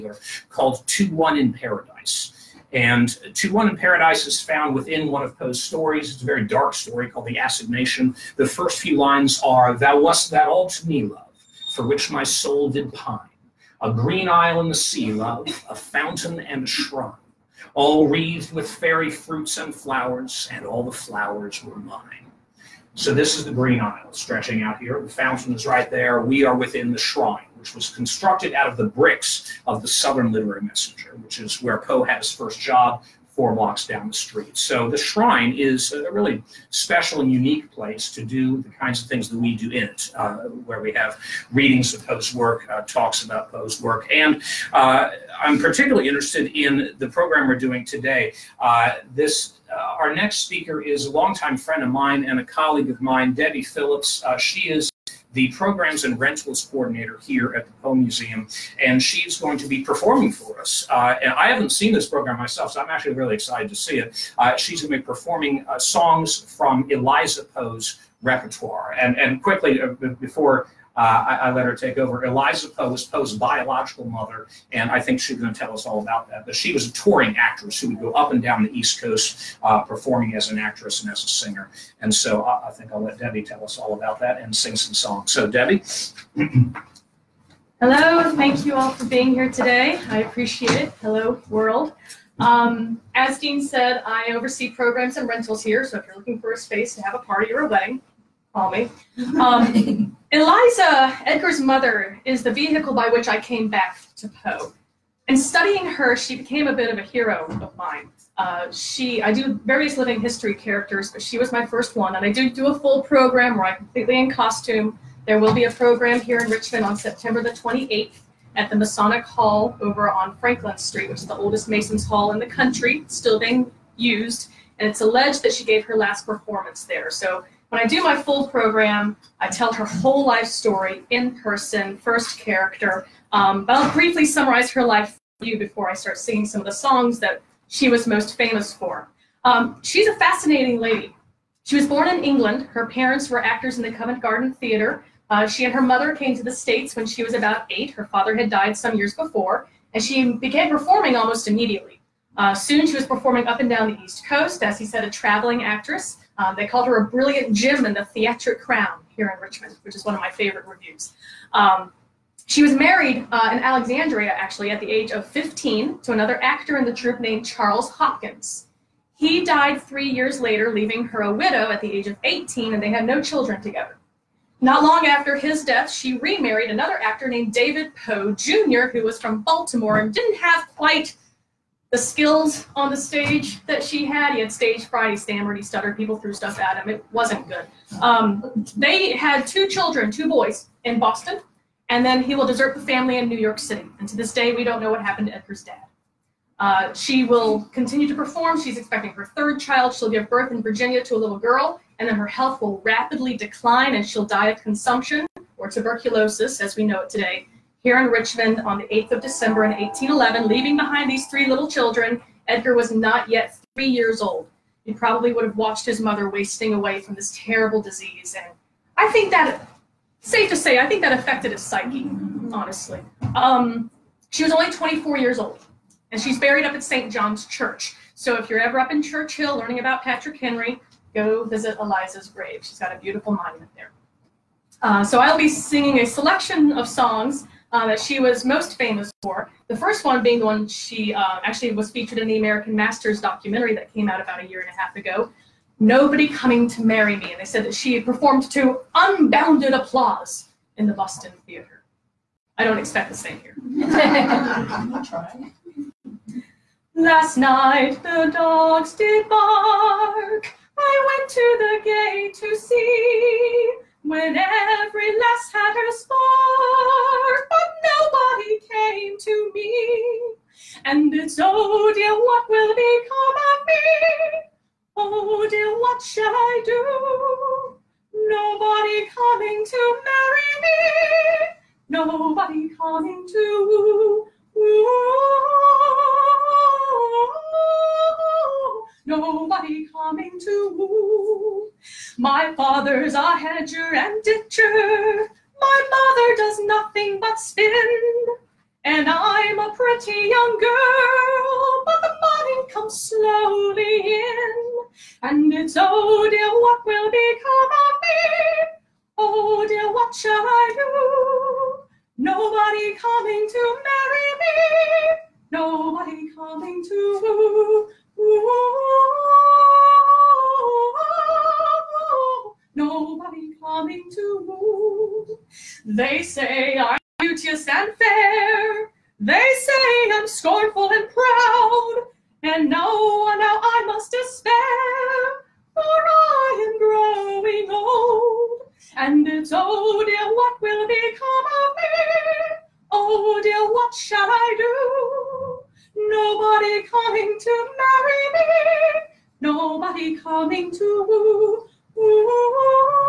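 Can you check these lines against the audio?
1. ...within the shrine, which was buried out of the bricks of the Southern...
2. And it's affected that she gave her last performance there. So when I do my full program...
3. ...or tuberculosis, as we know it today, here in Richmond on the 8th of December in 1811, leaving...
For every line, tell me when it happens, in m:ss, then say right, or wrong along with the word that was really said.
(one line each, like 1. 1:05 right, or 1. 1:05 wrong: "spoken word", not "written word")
1. 0:26 wrong: "constructed", not "buried"
2. 2:04 wrong: "alleged", not "affected"
3. 3:25 right.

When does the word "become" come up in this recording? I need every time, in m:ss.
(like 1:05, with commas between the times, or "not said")
4:32, 5:07, 5:40.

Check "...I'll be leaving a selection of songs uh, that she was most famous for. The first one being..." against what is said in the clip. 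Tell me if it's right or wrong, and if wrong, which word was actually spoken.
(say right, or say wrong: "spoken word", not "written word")
wrong: "singing", not "leaving".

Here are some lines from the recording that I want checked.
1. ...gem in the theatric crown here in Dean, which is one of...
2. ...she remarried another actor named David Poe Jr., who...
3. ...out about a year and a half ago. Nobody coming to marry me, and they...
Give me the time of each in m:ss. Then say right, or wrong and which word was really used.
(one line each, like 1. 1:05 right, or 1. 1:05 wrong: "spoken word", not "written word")
1. 2:37 wrong: "Richmond", not "Dean"
2. 2:55 right
3. 4:04 right.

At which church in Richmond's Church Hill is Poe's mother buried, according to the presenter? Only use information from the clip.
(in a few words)
St. John's Church.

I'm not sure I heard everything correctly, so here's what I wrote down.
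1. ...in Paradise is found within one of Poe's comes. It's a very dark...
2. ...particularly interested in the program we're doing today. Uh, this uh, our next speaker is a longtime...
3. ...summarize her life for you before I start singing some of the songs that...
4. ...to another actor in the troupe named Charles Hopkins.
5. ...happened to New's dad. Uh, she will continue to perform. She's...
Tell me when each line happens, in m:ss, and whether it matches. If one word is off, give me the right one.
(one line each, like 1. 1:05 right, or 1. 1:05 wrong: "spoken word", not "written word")
1. 0:03 wrong: "stories", not "comes"
2. 0:45 right
3. 2:14 right
4. 2:45 right
5. 3:15 wrong: "Edgar", not "New".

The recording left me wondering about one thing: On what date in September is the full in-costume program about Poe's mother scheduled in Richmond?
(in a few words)
September 28.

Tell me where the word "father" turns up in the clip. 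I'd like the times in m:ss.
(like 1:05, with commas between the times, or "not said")
2:28, 4:52.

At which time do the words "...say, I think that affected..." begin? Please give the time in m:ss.
3:40.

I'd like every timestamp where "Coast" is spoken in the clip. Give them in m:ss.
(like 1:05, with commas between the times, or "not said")
1:19, 2:34.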